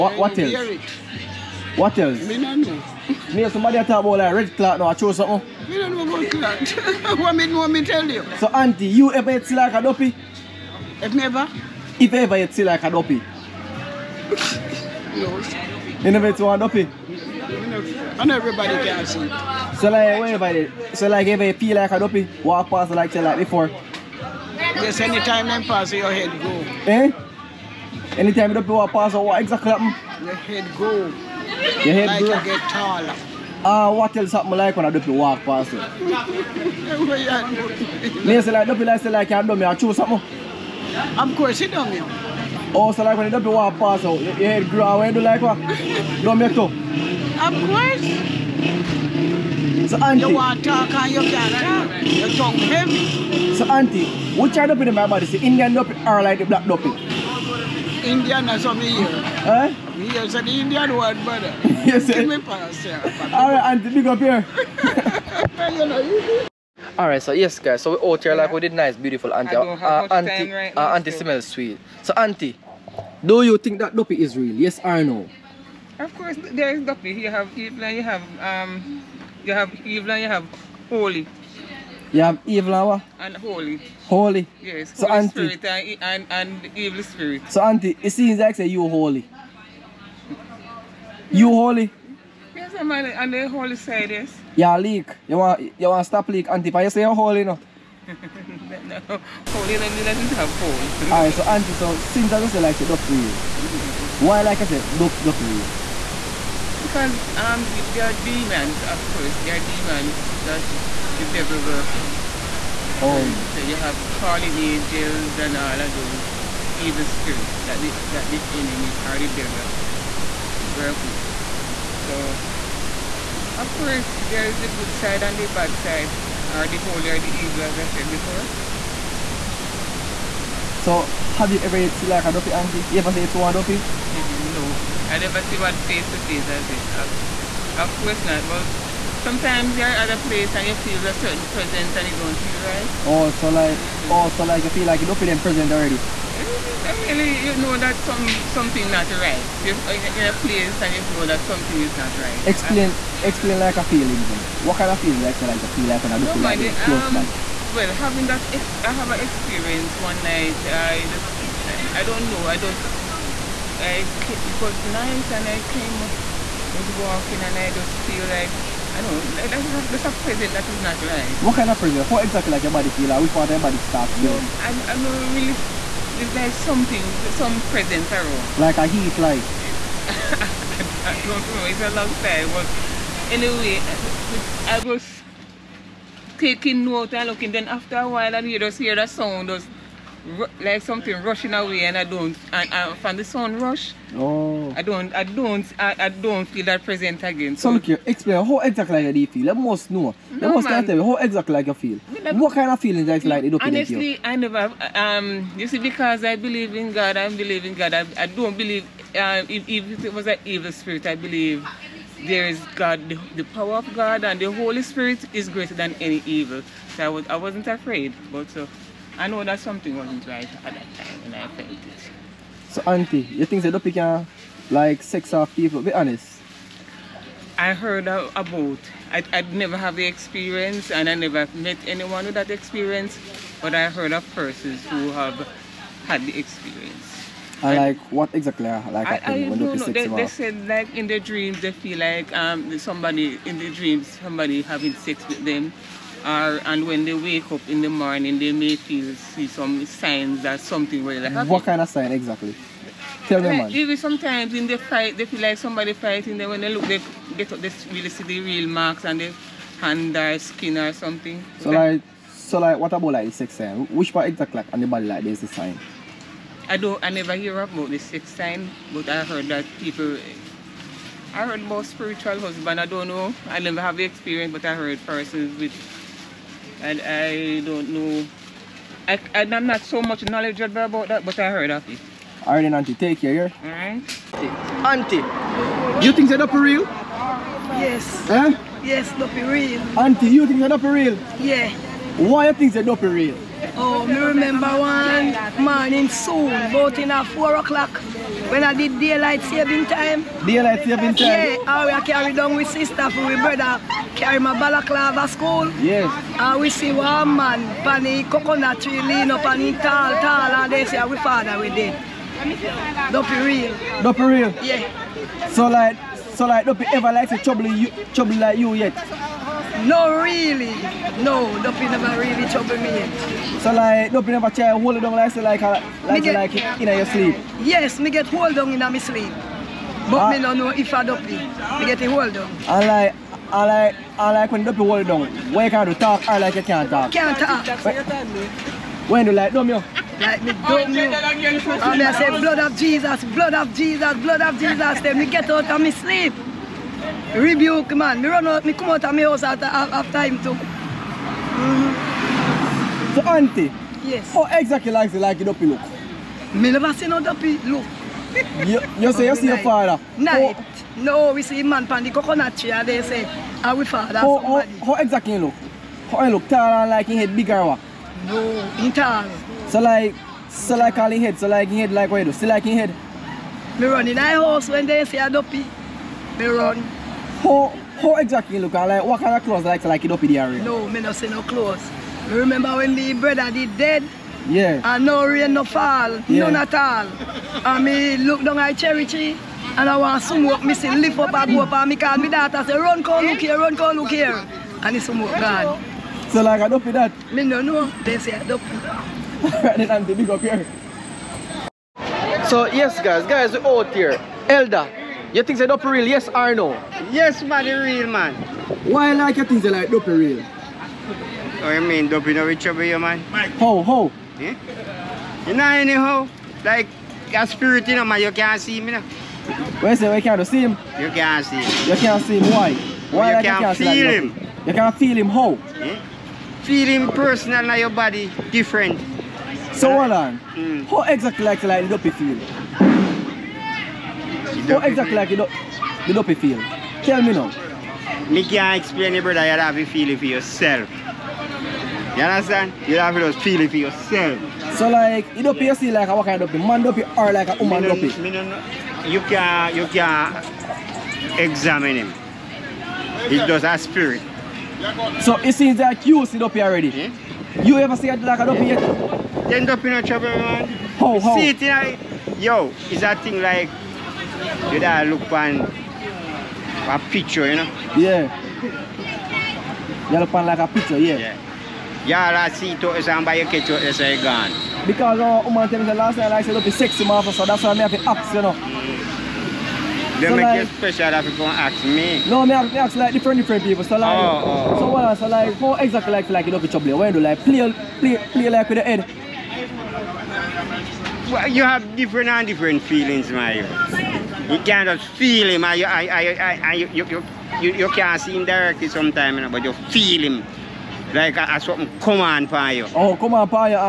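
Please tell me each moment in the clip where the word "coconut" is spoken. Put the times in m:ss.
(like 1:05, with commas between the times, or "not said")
5:08, 6:02.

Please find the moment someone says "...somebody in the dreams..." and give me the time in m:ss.
4:02.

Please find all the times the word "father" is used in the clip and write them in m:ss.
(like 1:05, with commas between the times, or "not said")
5:11, 5:59, 6:03.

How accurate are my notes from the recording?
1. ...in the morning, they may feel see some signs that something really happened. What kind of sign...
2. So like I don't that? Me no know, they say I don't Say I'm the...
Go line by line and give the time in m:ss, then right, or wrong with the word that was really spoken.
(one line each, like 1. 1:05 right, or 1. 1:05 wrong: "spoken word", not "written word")
1. 4:07 right
2. 6:36 wrong: "Then", not "Say".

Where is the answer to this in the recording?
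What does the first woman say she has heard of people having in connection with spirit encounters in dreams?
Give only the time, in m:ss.
4:31.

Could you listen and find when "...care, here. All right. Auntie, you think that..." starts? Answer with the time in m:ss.
4:43.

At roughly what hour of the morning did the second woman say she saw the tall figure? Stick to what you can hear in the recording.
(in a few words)
4 o'clock.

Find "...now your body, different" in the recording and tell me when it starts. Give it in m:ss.
7:07.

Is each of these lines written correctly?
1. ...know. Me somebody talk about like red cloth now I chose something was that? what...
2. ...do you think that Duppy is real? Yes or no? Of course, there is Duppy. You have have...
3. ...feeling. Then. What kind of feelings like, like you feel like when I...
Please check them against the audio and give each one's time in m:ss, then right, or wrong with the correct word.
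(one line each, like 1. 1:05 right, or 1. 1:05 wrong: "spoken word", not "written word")
1. 0:02 right
2. 1:13 right
3. 2:33 right.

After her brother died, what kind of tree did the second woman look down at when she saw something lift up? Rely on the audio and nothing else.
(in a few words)
cherry tree.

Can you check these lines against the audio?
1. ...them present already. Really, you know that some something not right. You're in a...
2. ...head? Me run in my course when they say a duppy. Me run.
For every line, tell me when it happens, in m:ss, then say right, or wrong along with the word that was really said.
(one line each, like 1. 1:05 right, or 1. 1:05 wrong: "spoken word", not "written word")
1. 2:25 right
2. 6:12 wrong: "house", not "course".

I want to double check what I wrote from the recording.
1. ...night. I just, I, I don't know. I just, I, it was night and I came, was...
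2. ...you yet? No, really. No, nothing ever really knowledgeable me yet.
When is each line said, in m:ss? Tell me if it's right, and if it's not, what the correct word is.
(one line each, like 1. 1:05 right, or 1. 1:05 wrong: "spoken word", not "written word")
1. 2:40 right
2. 5:18 wrong: "trouble", not "knowledgeable".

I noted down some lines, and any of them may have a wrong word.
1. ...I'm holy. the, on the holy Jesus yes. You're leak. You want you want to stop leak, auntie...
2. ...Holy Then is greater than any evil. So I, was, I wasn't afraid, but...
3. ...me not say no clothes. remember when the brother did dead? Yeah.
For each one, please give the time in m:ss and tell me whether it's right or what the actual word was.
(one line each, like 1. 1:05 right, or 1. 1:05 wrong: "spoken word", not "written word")
1. 1:32 wrong: "Say", not "Jesus"
2. 3:34 wrong: "Spirit", not "Then"
3. 6:20 right.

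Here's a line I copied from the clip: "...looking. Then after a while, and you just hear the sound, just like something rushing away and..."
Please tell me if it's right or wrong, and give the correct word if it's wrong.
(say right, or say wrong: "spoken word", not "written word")
right.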